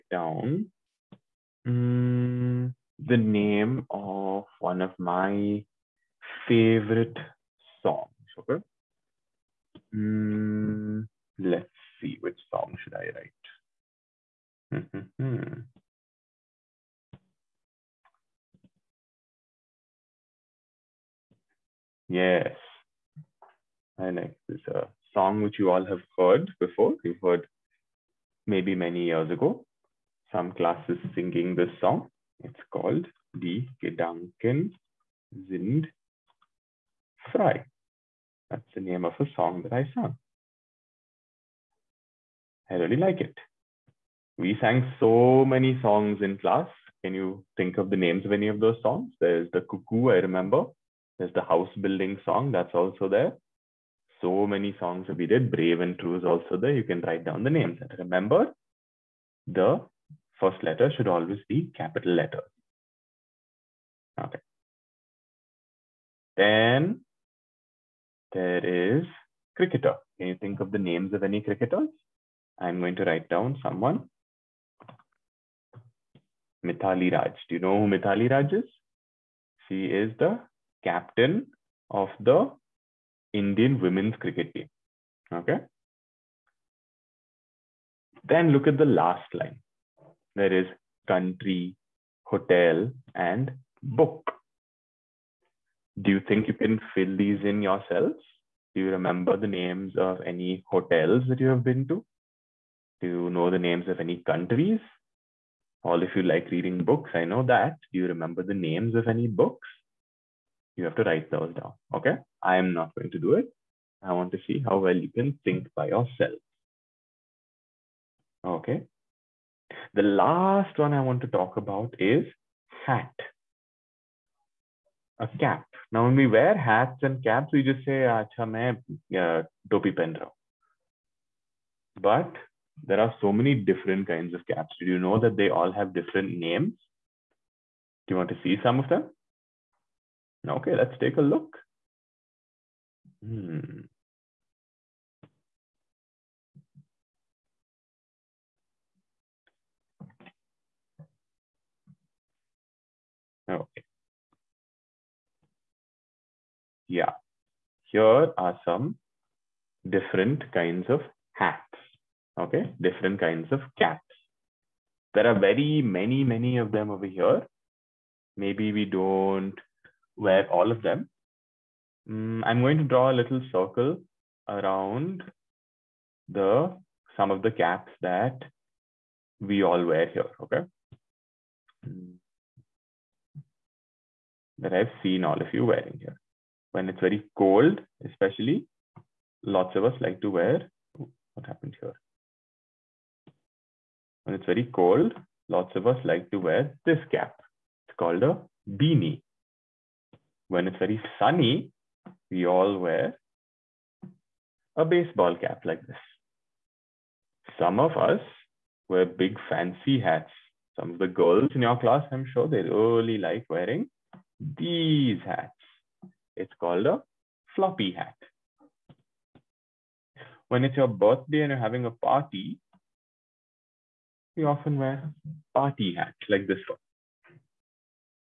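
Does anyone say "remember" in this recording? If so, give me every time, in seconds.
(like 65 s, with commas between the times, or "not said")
50 s, 57 s, 98 s, 108 s.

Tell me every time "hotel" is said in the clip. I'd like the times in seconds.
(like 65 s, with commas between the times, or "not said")
92 s, 100 s.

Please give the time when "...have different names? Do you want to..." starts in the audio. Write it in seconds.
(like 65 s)
135 s.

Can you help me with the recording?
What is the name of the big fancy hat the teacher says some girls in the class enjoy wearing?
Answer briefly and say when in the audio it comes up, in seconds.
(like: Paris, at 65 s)
floppy hat, at 217 s.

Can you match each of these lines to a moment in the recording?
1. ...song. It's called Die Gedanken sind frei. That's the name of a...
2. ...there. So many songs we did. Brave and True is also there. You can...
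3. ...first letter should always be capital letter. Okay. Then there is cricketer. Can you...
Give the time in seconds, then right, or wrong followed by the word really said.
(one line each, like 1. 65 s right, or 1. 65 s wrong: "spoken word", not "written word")
1. 31 s right
2. 53 s right
3. 60 s right.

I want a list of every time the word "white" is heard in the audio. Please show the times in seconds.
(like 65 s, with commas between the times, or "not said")
not said.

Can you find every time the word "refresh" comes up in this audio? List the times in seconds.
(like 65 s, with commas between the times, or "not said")
not said.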